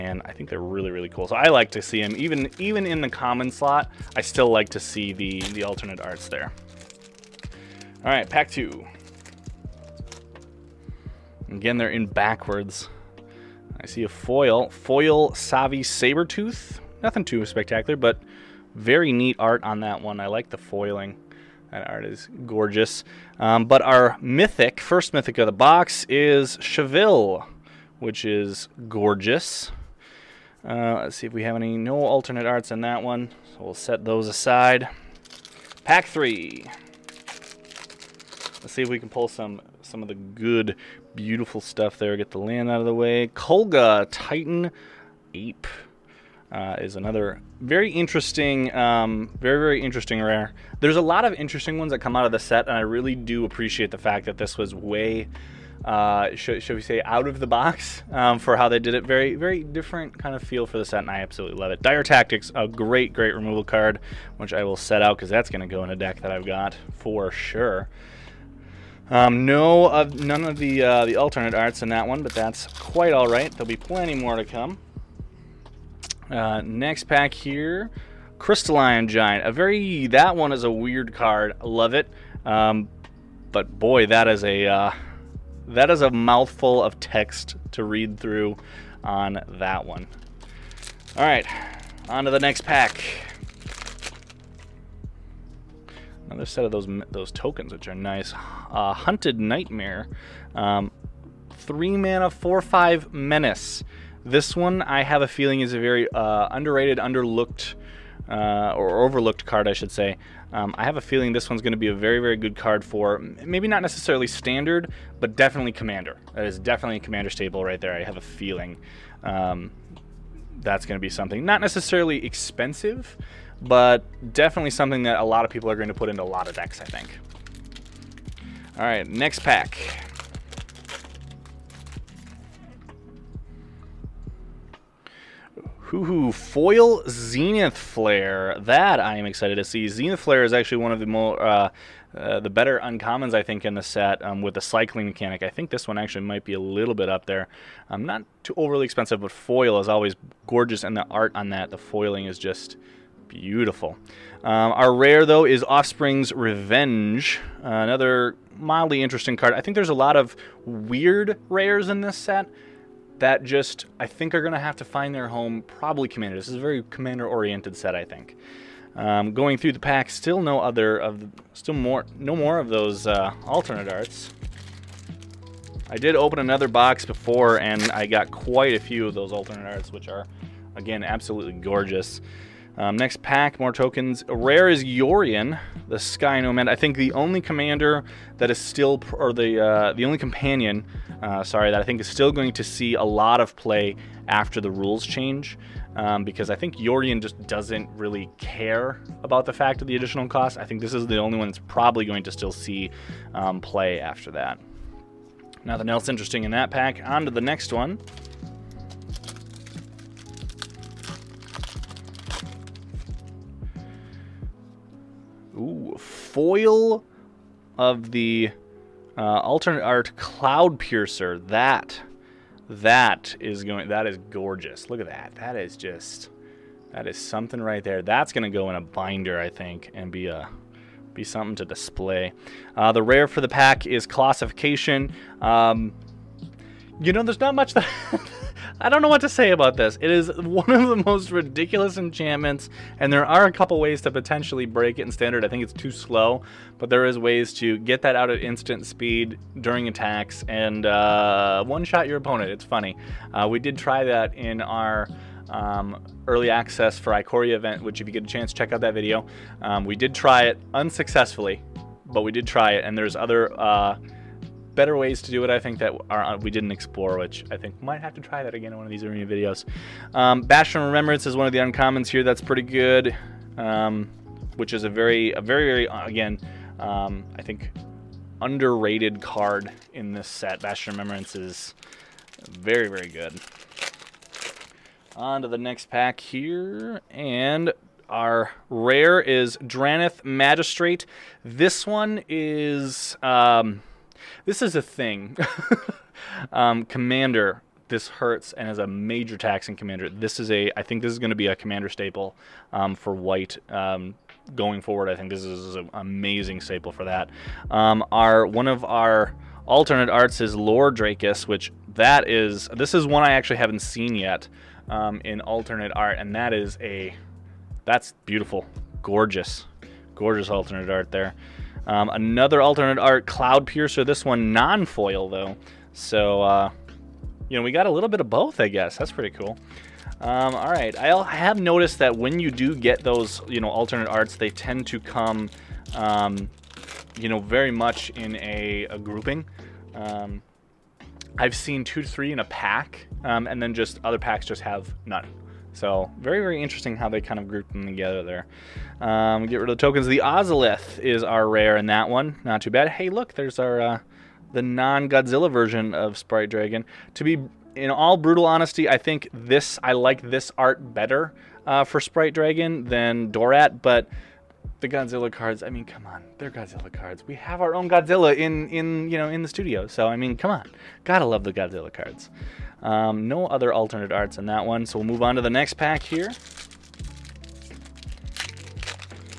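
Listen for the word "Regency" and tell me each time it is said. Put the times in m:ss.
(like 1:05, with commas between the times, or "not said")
not said.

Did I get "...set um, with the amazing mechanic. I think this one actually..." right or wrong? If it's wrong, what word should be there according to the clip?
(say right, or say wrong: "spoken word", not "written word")
wrong: "cycling", not "amazing".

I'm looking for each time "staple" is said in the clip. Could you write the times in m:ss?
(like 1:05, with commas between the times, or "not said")
1:57, 5:01, 5:06.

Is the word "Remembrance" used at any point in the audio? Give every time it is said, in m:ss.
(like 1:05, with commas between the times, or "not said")
4:30, 4:40.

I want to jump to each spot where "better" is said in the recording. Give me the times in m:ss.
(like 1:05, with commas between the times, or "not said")
2:22, 4:24, 6:00.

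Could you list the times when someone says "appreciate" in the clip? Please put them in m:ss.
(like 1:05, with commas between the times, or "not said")
0:53.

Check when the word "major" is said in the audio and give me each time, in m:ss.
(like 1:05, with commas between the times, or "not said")
4:58.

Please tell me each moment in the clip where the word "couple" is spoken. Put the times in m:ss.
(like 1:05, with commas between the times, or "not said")
4:03.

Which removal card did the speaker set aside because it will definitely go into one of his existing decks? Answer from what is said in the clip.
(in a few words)
Dire Tactics.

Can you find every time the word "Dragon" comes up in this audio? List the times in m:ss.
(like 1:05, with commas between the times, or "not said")
5:56, 6:02.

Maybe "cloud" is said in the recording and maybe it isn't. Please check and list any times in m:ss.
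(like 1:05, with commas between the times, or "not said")
3:40, 5:23.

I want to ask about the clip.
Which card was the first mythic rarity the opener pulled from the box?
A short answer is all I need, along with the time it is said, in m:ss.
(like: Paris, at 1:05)
Chevill, at 0:26.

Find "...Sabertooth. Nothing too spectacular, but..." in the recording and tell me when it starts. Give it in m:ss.
0:15.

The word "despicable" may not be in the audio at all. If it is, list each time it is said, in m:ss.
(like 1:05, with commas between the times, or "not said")
not said.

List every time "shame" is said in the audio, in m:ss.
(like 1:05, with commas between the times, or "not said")
not said.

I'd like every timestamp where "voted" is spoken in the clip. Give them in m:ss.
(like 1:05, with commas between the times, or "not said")
not said.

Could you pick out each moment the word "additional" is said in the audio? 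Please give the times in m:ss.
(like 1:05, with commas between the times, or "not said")
3:19.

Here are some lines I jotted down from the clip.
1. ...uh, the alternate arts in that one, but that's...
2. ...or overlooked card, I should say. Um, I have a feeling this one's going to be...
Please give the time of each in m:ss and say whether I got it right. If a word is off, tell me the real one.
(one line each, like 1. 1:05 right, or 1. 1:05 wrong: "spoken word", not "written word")
1. 1:10 right
2. 1:48 right.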